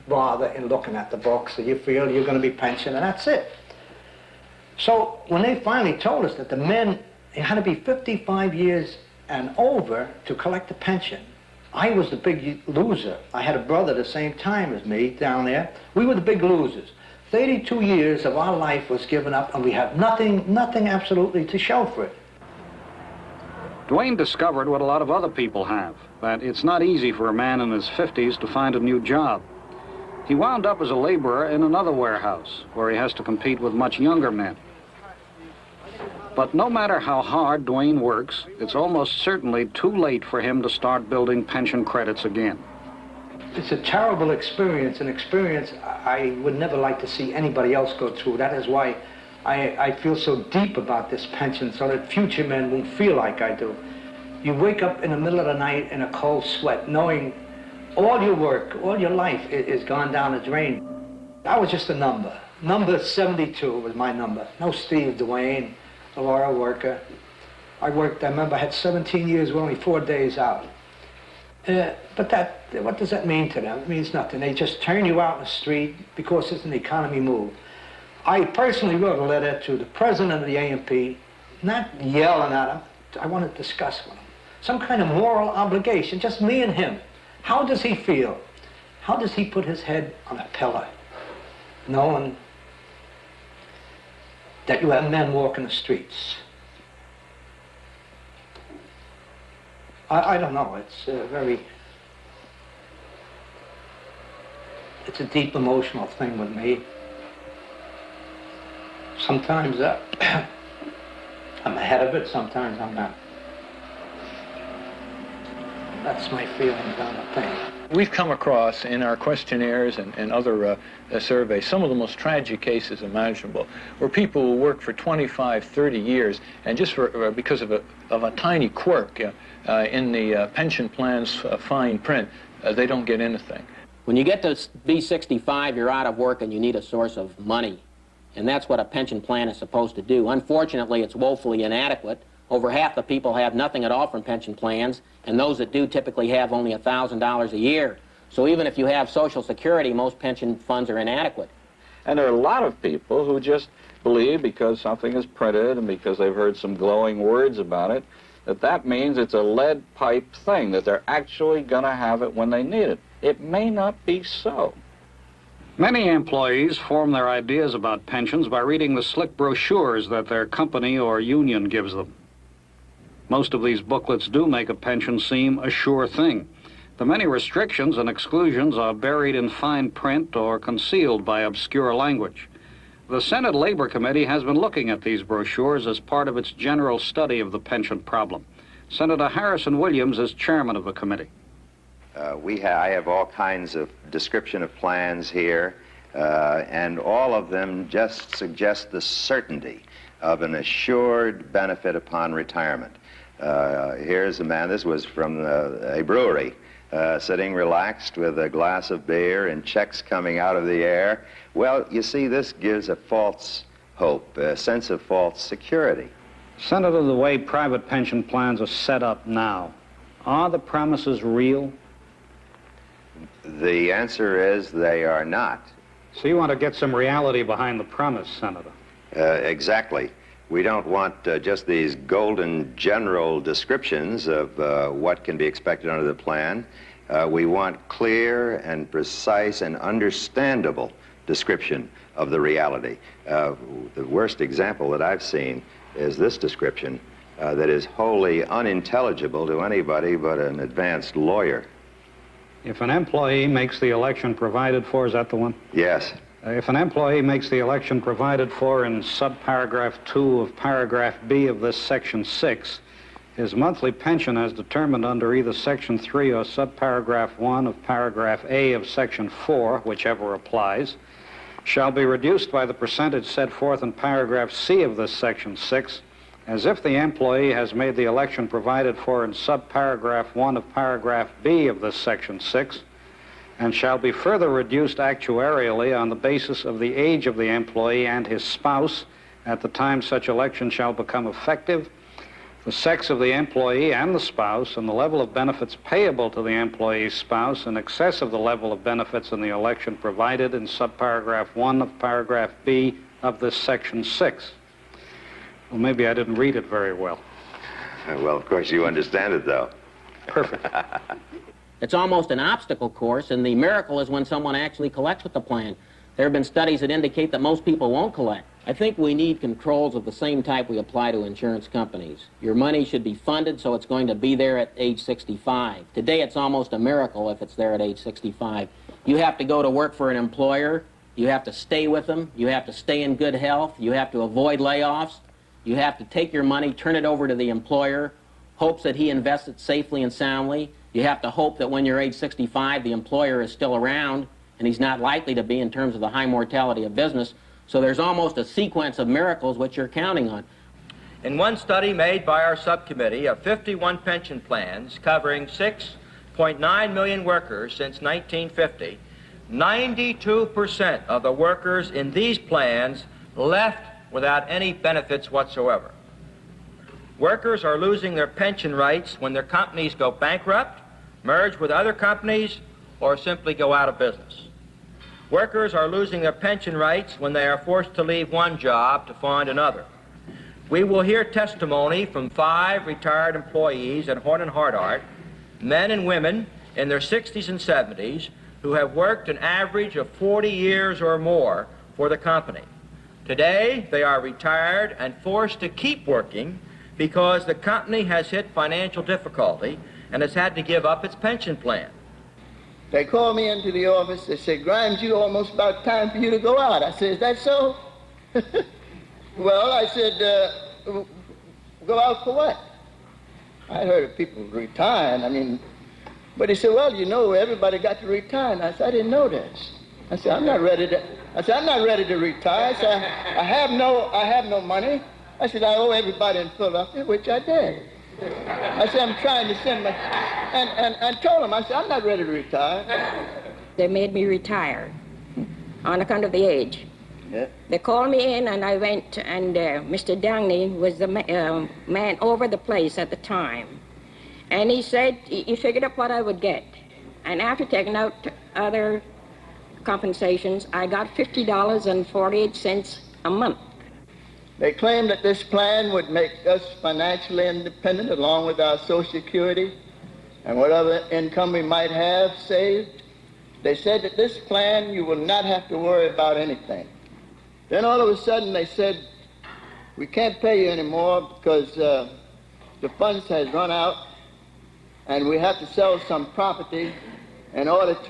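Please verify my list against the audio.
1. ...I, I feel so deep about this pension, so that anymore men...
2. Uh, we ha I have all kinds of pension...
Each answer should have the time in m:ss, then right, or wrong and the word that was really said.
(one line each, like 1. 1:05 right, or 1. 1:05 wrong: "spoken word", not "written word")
1. 0:49 wrong: "future", not "anymore"
2. 3:12 wrong: "description", not "pension".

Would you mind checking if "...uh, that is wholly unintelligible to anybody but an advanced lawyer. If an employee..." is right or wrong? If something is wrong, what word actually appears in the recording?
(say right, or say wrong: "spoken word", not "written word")
right.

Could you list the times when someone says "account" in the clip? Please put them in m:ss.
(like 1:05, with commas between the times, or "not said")
7:16.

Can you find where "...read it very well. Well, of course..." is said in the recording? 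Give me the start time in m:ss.
5:06.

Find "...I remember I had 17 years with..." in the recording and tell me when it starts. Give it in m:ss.
1:08.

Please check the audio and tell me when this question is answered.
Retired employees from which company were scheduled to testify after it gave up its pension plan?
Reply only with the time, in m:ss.
6:24.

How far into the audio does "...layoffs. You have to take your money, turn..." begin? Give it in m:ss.
5:34.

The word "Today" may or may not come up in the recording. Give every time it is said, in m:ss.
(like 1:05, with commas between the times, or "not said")
5:25, 6:33.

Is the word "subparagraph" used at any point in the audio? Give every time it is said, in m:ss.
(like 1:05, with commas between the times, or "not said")
4:19, 4:26, 4:39, 5:00.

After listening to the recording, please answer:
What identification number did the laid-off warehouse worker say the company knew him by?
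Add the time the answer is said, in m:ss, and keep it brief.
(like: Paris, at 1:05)
72, at 1:02.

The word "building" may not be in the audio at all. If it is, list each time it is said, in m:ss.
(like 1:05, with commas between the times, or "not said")
0:41.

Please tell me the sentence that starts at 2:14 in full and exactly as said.
When you get to be 65, you're out of work and you need a source of money.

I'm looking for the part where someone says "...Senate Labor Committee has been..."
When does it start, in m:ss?
3:03.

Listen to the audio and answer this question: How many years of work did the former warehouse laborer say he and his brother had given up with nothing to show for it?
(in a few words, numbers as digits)
32.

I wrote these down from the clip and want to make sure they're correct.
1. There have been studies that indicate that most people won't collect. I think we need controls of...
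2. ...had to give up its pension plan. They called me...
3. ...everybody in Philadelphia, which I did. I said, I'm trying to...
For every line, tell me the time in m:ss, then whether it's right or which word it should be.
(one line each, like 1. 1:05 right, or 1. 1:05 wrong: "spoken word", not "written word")
1. 5:16 right
2. 6:40 right
3. 7:05 right.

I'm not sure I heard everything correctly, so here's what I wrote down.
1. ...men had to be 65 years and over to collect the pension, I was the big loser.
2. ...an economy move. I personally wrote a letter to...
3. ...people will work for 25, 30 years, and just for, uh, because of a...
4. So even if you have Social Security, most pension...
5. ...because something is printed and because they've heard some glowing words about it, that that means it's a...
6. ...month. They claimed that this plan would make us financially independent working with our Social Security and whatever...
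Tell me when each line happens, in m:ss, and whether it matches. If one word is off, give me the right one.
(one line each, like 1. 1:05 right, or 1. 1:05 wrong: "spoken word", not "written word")
1. 0:06 wrong: "55", not "65"
2. 1:16 right
3. 2:04 right
4. 2:28 right
5. 2:34 right
6. 7:33 wrong: "along", not "working".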